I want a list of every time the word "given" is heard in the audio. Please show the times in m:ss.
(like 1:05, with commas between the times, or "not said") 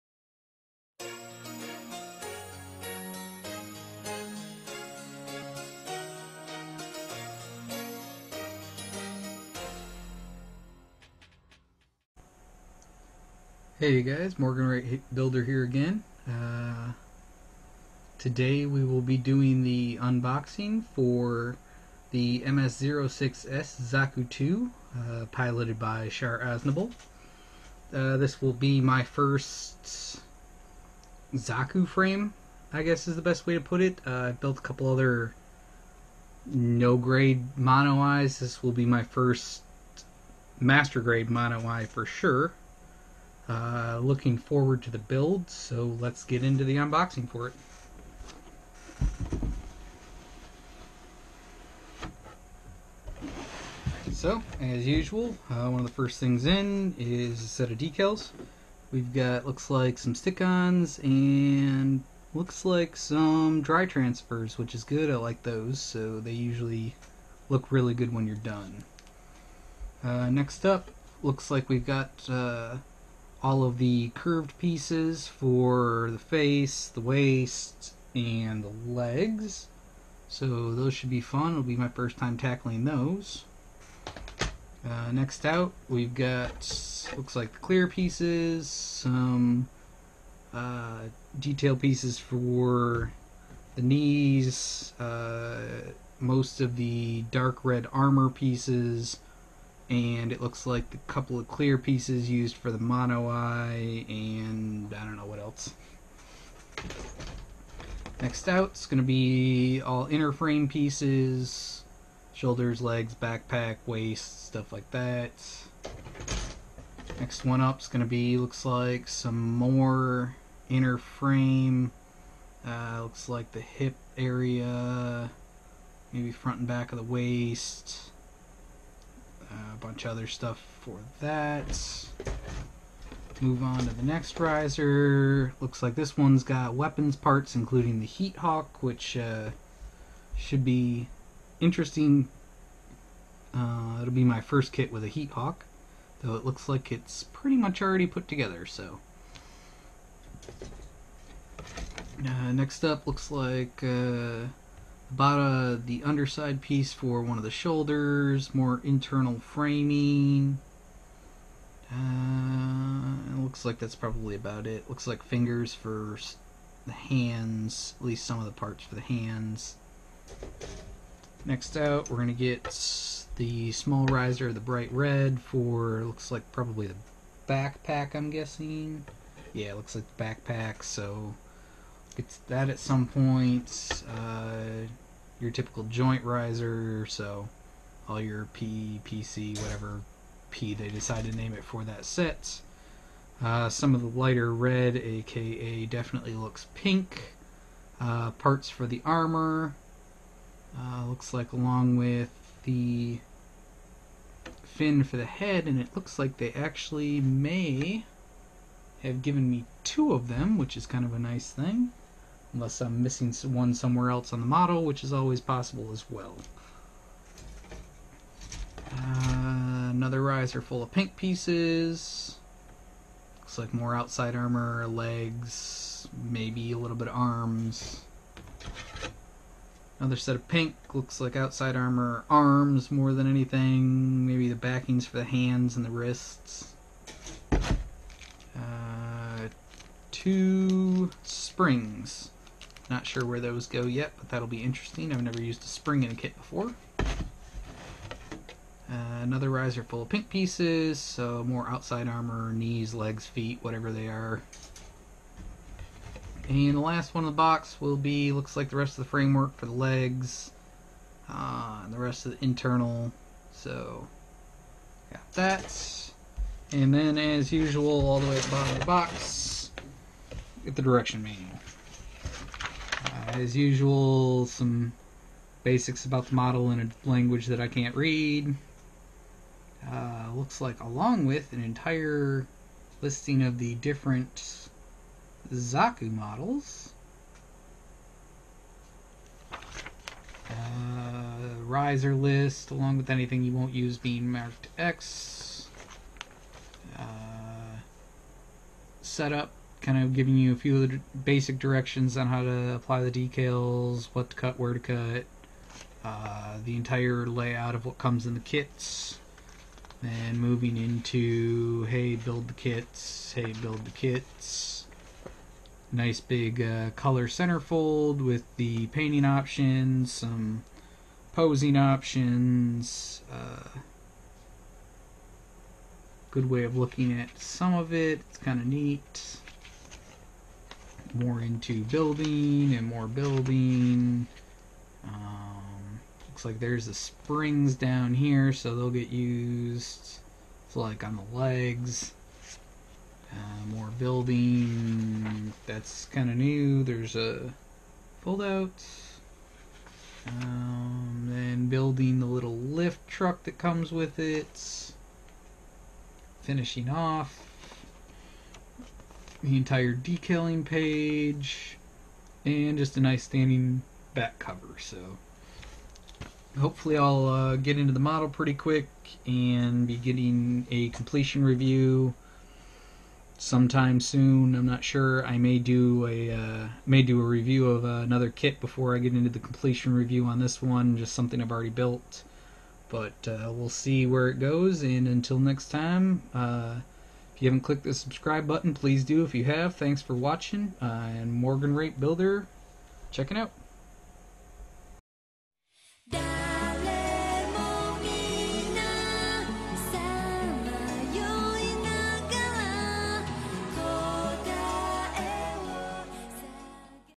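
3:29.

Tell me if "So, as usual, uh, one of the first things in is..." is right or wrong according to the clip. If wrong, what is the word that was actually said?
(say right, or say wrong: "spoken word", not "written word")
right.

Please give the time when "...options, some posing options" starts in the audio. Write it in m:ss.
5:19.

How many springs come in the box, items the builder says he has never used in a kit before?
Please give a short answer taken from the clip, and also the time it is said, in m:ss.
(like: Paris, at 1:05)
2, at 4:00.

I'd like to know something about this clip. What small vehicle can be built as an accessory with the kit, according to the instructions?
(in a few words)
Lift truck.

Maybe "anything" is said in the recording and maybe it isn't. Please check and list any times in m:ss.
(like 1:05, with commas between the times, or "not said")
3:53, 4:53.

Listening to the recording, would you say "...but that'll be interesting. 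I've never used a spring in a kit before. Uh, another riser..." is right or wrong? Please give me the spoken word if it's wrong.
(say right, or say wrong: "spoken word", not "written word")
right.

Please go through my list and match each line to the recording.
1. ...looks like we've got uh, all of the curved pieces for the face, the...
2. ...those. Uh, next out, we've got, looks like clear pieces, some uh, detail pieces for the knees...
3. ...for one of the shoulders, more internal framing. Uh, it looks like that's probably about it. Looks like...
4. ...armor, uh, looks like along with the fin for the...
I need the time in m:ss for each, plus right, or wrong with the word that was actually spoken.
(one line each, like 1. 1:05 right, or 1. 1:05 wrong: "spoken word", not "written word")
1. 1:11 right
2. 1:22 right
3. 2:36 right
4. 3:19 right.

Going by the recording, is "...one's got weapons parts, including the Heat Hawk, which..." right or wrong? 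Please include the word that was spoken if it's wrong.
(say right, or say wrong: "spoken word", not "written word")
right.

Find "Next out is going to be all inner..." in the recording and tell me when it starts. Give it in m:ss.
1:48.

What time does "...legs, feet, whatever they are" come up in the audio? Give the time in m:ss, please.
4:12.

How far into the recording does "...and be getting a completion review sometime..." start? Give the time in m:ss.
6:09.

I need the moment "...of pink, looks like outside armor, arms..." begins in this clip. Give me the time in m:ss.
3:50.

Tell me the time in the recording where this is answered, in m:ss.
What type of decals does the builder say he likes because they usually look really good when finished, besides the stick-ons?
1:03.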